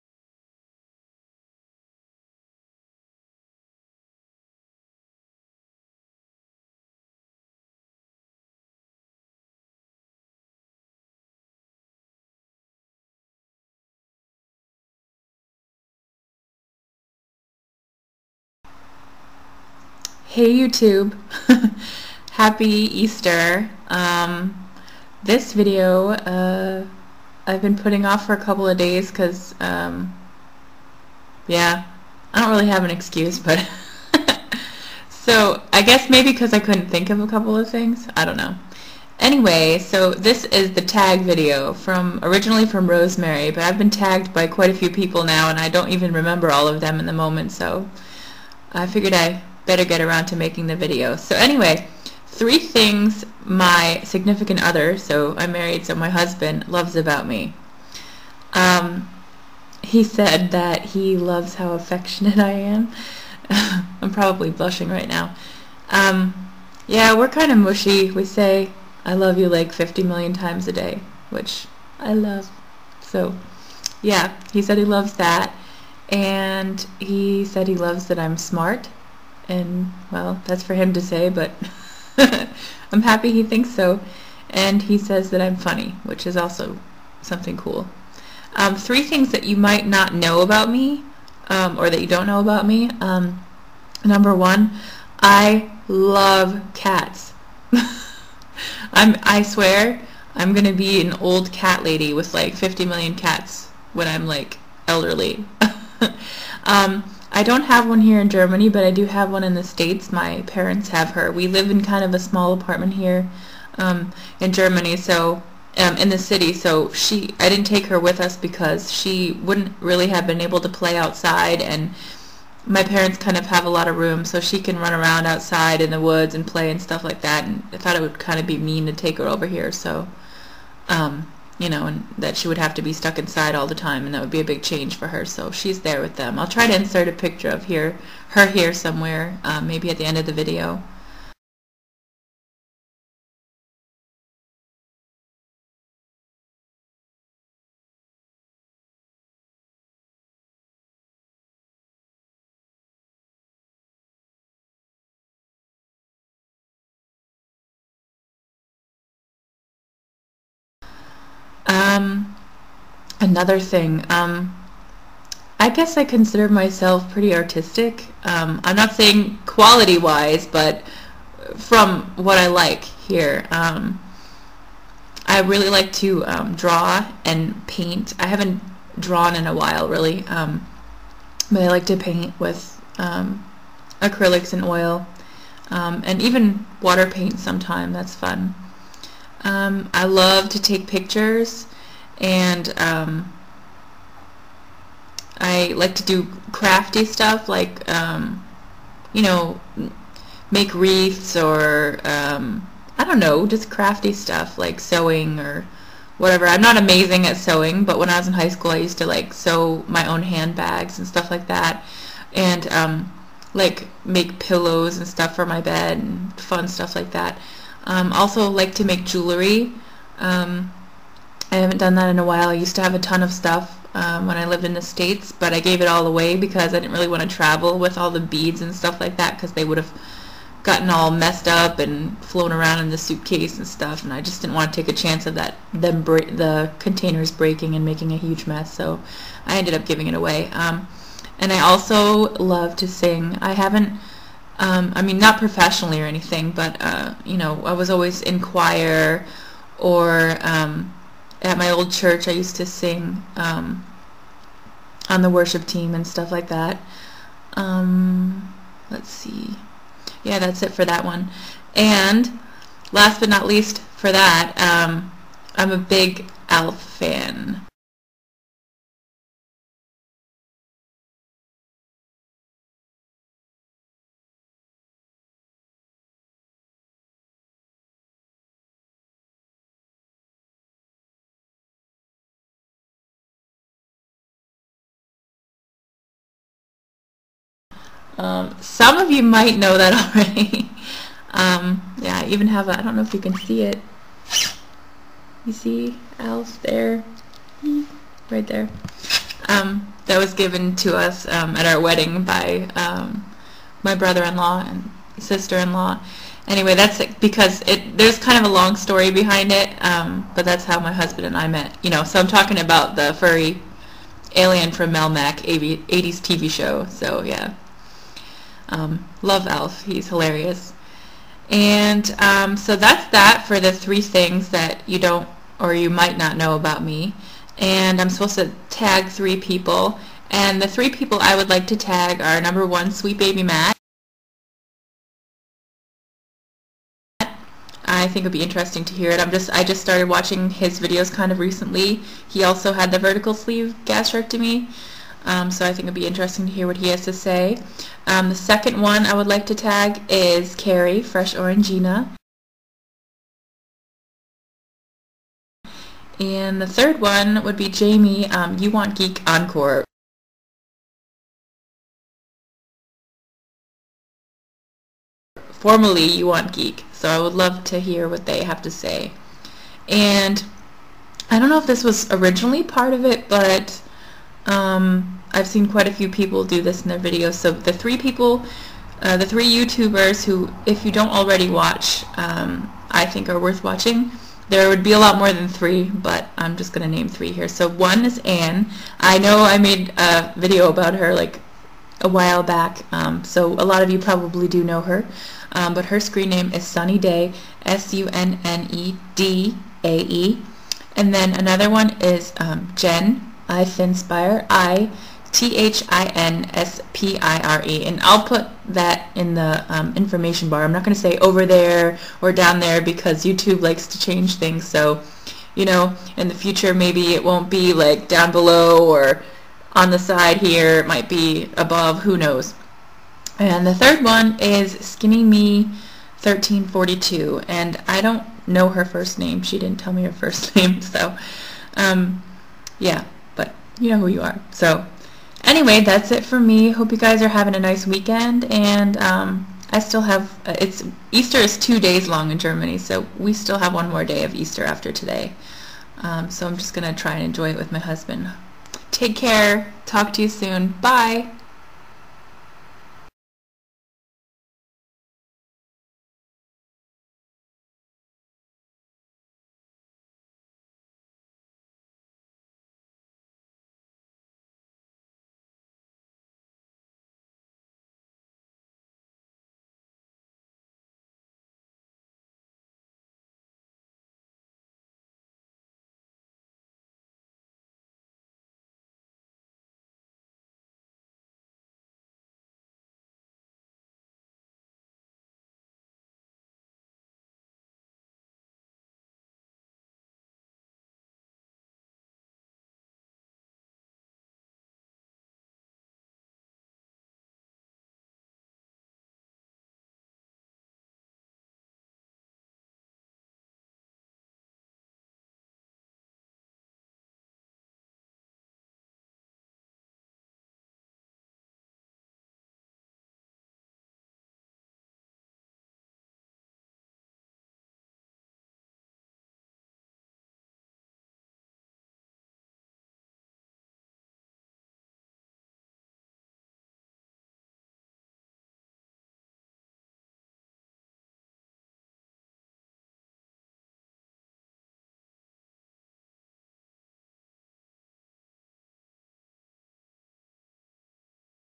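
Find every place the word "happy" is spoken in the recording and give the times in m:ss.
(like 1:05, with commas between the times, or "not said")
0:22, 1:23.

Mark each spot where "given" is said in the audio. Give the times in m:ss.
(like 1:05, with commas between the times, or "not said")
5:00.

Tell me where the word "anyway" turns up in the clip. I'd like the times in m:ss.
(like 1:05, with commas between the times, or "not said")
0:39, 0:51, 5:06, 7:15.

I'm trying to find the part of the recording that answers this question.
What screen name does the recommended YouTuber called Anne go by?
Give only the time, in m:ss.
6:36.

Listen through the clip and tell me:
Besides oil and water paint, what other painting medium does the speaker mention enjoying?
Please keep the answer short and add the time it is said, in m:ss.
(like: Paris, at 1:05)
acrylics, at 3:04.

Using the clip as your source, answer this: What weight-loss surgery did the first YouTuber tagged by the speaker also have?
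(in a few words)
vertical sleeve gastrectomy.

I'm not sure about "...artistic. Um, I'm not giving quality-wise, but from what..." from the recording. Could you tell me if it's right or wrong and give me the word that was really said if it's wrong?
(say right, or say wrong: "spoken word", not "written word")
wrong: "saying", not "giving".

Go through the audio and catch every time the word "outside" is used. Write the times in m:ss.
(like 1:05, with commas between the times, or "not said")
2:00, 2:05.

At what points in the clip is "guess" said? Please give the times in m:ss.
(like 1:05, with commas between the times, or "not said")
0:35, 2:45.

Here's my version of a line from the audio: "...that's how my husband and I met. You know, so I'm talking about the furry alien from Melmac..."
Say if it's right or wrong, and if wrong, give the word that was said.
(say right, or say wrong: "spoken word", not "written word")
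right.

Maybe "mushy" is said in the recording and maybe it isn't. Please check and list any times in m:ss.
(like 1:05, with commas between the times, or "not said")
1:07.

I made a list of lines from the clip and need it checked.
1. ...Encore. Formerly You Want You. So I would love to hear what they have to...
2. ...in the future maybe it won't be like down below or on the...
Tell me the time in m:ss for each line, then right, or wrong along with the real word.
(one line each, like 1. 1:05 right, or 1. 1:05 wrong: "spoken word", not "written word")
1. 5:59 wrong: "Geek", not "You"
2. 6:56 right.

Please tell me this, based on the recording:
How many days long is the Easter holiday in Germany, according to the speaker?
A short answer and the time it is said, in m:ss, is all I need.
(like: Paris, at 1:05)
2, at 7:21.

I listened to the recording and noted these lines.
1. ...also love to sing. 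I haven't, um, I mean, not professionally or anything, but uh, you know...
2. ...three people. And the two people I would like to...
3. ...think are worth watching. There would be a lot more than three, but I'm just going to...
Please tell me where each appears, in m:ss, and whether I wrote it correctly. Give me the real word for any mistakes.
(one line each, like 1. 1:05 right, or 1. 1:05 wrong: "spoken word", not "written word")
1. 4:01 right
2. 5:29 wrong: "three", not "two"
3. 6:23 right.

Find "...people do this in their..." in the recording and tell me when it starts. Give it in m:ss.
6:16.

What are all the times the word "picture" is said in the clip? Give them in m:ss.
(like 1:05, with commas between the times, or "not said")
2:17, 3:10.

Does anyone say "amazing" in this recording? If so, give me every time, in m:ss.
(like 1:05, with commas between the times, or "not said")
3:26.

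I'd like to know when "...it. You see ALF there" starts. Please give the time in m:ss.
4:53.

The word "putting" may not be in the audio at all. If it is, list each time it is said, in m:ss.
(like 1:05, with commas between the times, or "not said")
0:27.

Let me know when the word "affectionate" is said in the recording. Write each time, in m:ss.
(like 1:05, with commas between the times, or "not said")
1:01.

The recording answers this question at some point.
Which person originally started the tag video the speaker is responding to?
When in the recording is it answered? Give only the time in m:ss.
0:42.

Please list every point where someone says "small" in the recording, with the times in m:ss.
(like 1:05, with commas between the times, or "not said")
1:52.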